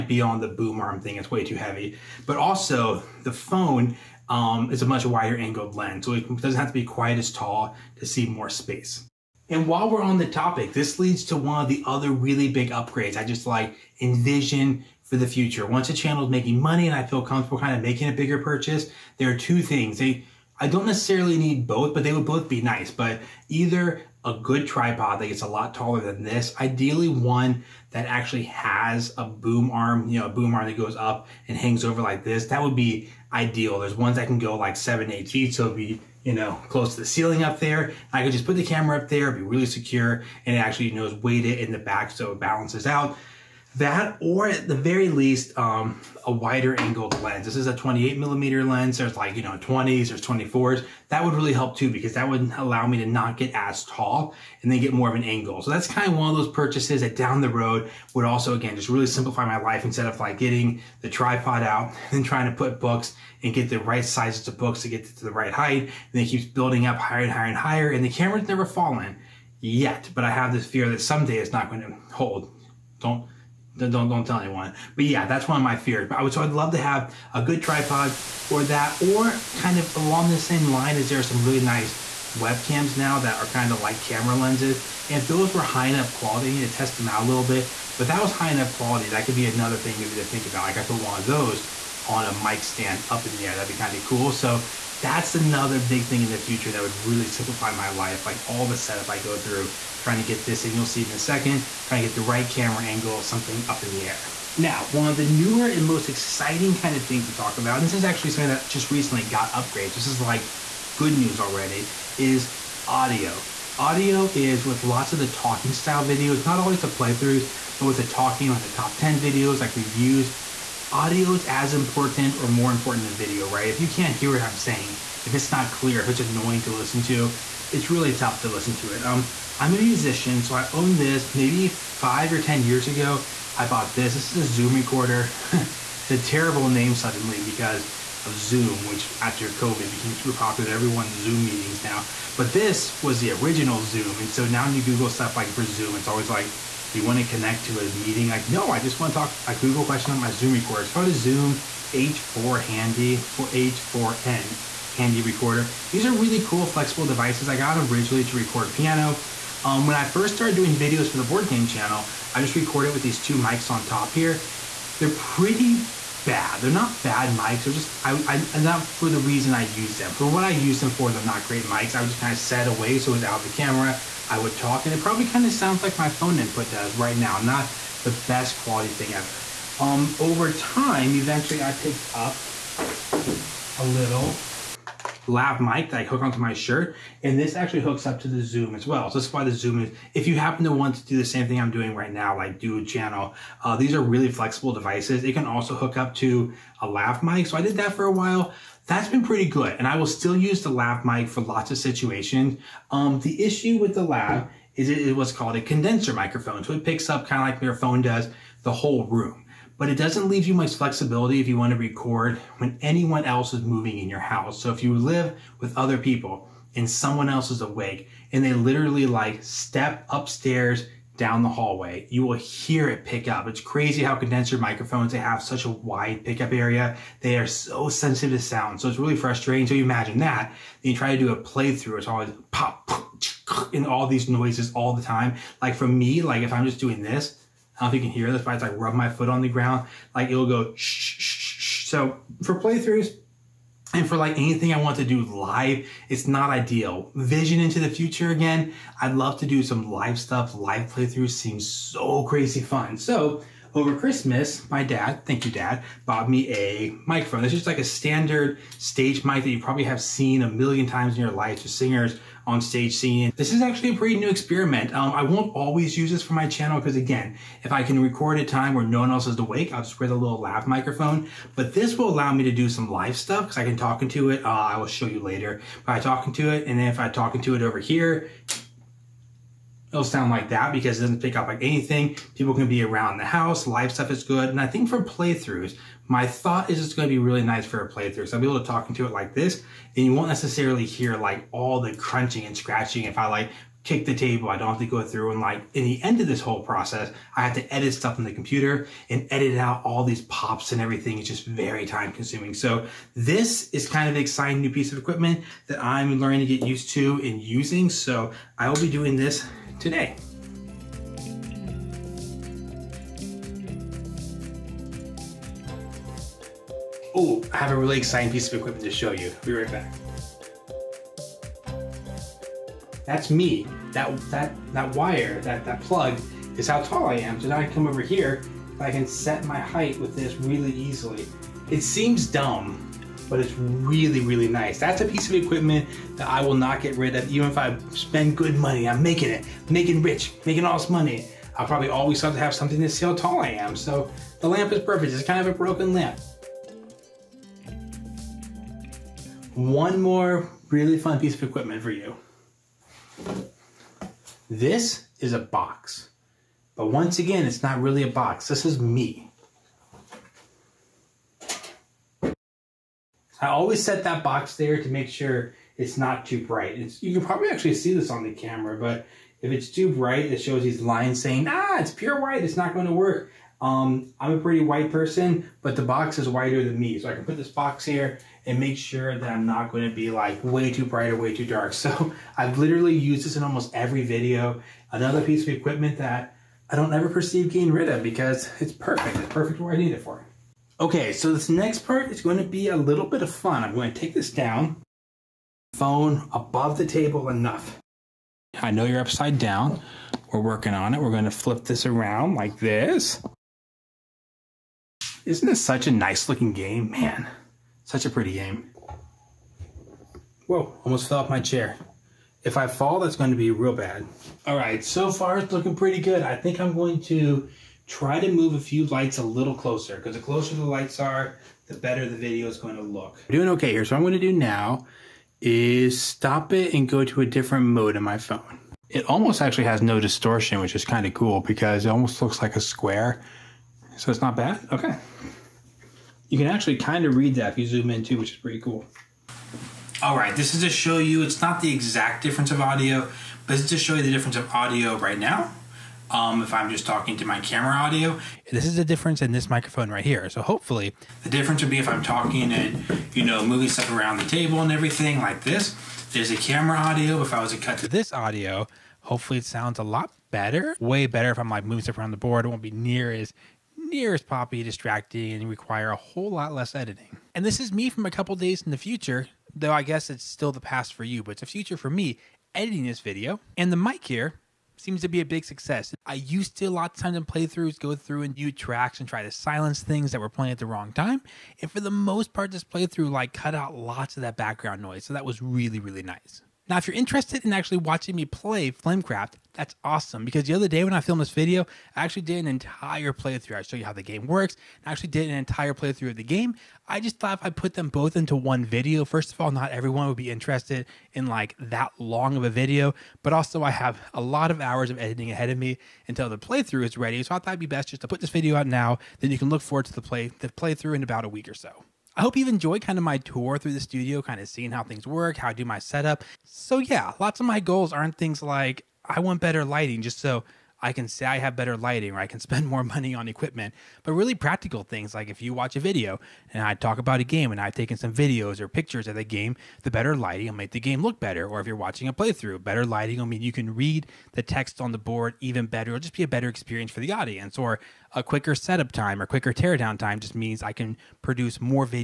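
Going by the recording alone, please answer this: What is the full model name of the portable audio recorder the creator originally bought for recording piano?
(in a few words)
Zoom H4N Handy.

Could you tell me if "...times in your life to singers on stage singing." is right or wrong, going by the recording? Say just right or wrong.
right.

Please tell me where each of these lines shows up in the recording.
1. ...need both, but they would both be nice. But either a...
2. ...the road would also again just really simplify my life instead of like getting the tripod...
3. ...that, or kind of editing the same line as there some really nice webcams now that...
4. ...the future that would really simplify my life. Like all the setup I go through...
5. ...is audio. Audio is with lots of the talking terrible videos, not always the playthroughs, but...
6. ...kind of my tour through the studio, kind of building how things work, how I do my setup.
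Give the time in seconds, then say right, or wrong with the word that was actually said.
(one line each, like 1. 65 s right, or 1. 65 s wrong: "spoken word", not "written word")
1. 21 s right
2. 57 s right
3. 78 s wrong: "along", not "editing"
4. 96 s right
5. 112 s wrong: "style", not "terrible"
6. 512 s wrong: "seeing", not "building".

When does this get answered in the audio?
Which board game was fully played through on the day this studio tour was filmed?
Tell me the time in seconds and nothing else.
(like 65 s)
488 s.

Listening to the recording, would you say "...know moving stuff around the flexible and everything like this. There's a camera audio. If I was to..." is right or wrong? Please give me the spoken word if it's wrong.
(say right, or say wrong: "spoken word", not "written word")
wrong: "table", not "flexible".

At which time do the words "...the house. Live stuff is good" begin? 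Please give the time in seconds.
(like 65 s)
283 s.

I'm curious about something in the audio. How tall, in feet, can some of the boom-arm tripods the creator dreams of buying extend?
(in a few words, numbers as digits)
seven, eight feet.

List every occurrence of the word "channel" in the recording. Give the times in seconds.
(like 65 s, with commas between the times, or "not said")
15 s, 161 s, 192 s, 266 s.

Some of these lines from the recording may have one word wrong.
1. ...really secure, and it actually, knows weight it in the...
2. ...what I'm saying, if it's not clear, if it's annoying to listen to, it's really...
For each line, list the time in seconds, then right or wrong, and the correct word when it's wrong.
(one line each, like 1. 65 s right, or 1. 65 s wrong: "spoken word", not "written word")
1. 39 s right
2. 124 s right.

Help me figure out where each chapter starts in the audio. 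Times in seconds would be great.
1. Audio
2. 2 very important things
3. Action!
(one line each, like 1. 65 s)
1. 103 s
2. 316 s
3. 439 s.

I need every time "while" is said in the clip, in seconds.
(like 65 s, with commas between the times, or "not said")
9 s, 198 s.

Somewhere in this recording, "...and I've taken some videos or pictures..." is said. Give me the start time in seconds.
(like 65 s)
527 s.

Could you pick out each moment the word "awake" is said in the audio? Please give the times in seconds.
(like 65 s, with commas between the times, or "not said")
217 s, 269 s.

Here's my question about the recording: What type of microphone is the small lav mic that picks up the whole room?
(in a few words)
condenser microphone.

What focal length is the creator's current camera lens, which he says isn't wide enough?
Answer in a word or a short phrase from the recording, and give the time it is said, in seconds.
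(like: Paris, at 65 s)
28 millimeter, at 47 s.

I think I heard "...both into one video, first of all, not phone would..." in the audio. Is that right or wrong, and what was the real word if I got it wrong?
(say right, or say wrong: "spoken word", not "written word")
wrong: "everyone", not "phone".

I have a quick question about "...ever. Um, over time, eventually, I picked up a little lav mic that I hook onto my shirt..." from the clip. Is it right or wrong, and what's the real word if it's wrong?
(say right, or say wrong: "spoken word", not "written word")
right.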